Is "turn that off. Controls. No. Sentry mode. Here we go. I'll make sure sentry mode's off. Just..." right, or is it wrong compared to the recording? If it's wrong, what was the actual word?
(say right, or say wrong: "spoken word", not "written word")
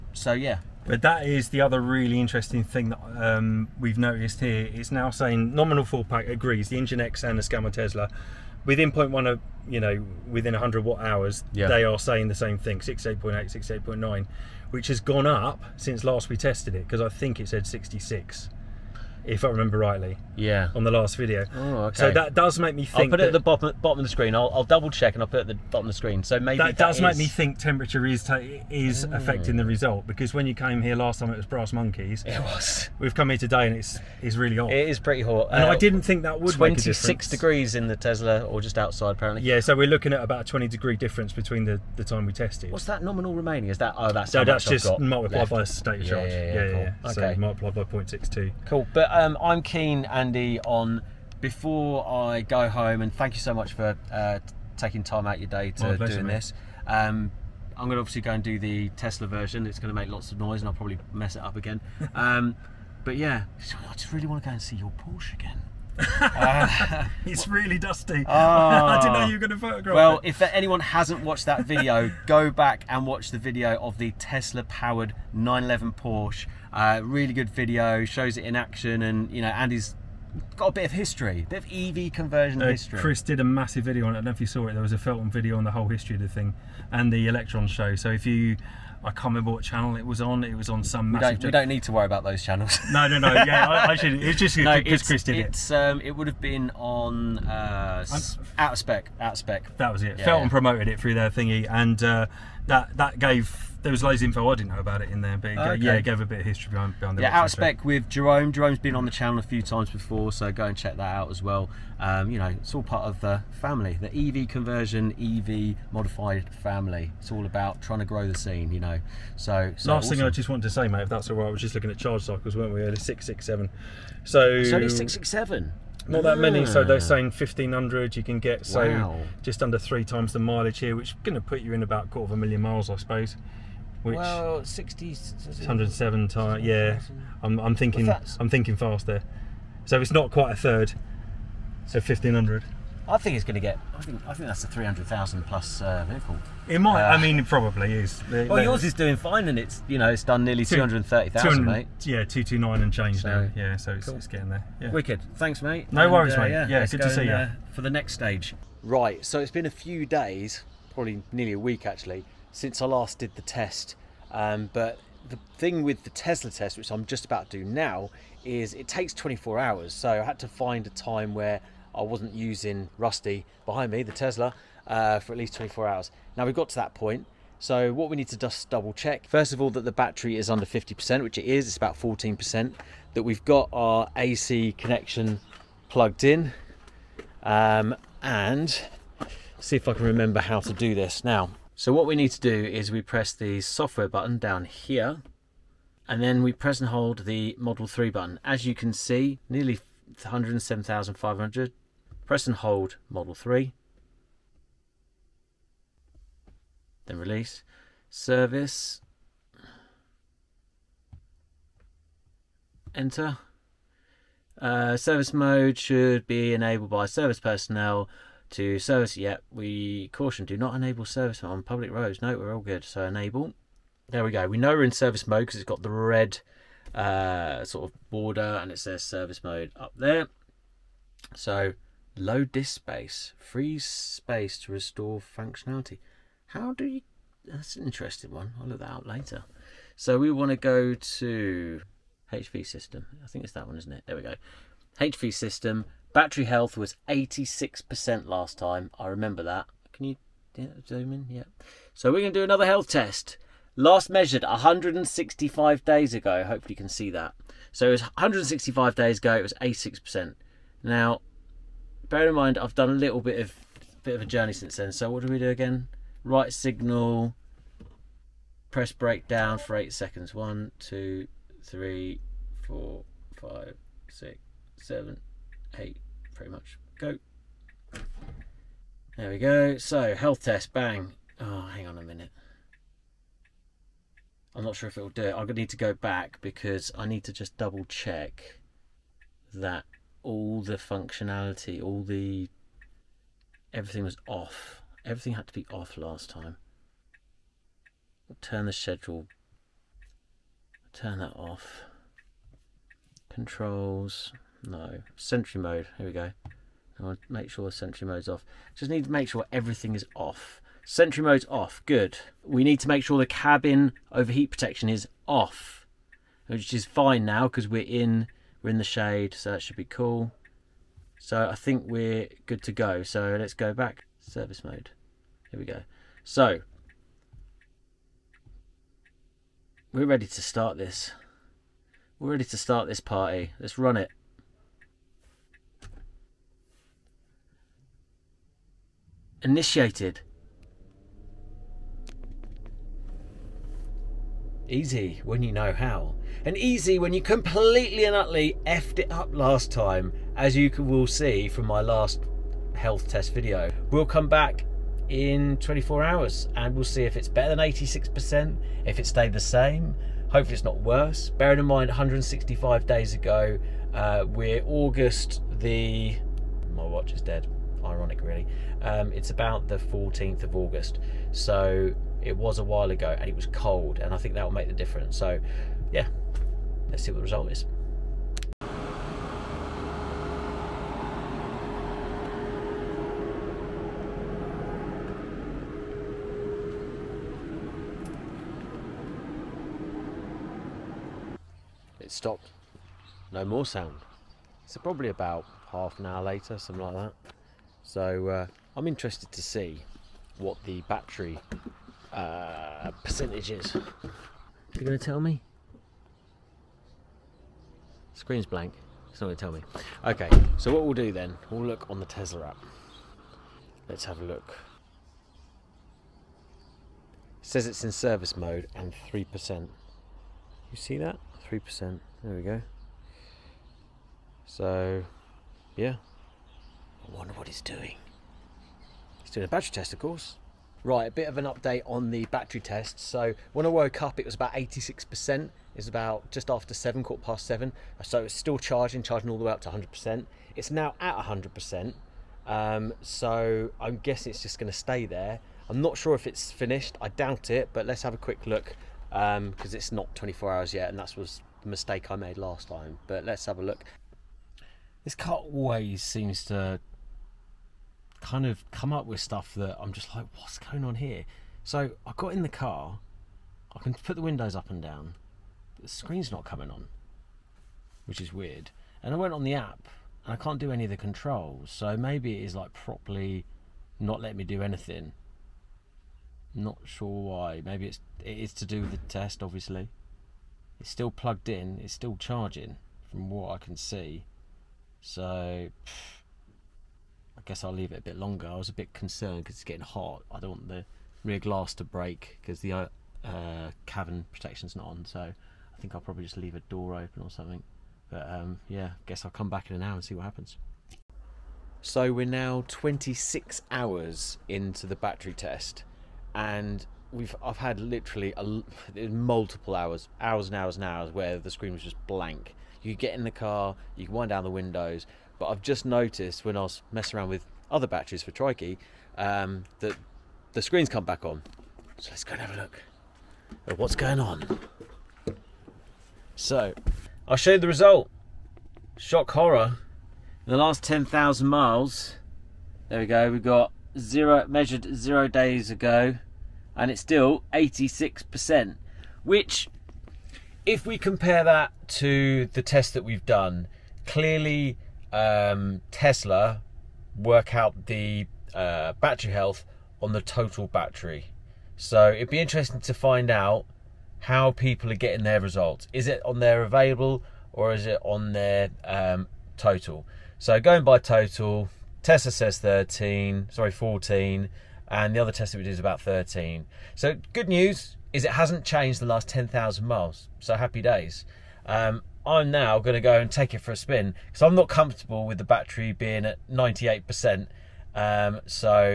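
right.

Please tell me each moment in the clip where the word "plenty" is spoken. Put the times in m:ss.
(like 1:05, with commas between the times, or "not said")
not said.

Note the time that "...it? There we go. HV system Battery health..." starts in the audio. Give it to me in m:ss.
4:03.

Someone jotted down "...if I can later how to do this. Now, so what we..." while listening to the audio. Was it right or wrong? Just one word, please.
wrong.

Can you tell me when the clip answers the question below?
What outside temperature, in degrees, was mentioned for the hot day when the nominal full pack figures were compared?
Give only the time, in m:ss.
0:36.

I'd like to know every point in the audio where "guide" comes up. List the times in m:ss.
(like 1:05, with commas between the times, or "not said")
not said.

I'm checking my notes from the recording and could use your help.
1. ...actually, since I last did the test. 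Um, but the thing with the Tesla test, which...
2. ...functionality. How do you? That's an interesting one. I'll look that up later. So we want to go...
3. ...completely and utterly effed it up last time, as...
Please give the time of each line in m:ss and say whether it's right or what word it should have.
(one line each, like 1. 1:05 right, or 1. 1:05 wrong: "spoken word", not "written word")
1. 2:41 right
2. 3:55 right
3. 5:47 right.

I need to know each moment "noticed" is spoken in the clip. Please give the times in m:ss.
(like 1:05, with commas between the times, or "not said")
0:03, 8:35.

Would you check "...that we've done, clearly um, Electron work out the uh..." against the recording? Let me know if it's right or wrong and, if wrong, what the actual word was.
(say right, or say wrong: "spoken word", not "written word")
wrong: "Tesla", not "Electron".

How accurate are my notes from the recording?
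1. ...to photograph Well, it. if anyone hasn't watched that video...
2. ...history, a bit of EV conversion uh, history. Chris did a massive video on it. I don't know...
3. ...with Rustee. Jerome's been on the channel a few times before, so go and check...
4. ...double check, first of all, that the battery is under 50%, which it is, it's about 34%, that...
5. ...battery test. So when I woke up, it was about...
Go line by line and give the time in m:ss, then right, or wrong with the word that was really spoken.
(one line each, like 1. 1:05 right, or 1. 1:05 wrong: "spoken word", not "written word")
1. 1:09 right
2. 1:20 right
3. 1:47 wrong: "Jerome", not "Rustee"
4. 2:58 wrong: "14", not "34"
5. 7:12 right.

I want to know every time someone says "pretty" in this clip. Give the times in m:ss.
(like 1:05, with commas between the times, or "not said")
0:34, 4:36.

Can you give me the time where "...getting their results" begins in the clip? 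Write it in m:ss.
9:14.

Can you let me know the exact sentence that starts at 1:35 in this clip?
Um, it would have been on uh, out of spec.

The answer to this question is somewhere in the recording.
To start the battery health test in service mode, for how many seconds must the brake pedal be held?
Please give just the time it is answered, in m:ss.
4:29.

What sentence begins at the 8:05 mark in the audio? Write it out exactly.
So guess I'll leave it a bit longer.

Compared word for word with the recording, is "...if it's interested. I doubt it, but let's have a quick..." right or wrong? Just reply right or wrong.
wrong.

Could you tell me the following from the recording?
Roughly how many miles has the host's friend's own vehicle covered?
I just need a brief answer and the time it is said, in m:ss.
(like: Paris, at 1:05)
230,000, at 2:30.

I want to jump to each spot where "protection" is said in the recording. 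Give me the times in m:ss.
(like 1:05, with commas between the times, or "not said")
5:14, 8:14.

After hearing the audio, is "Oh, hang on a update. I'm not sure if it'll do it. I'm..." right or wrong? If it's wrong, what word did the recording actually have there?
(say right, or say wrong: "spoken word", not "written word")
wrong: "minute", not "update".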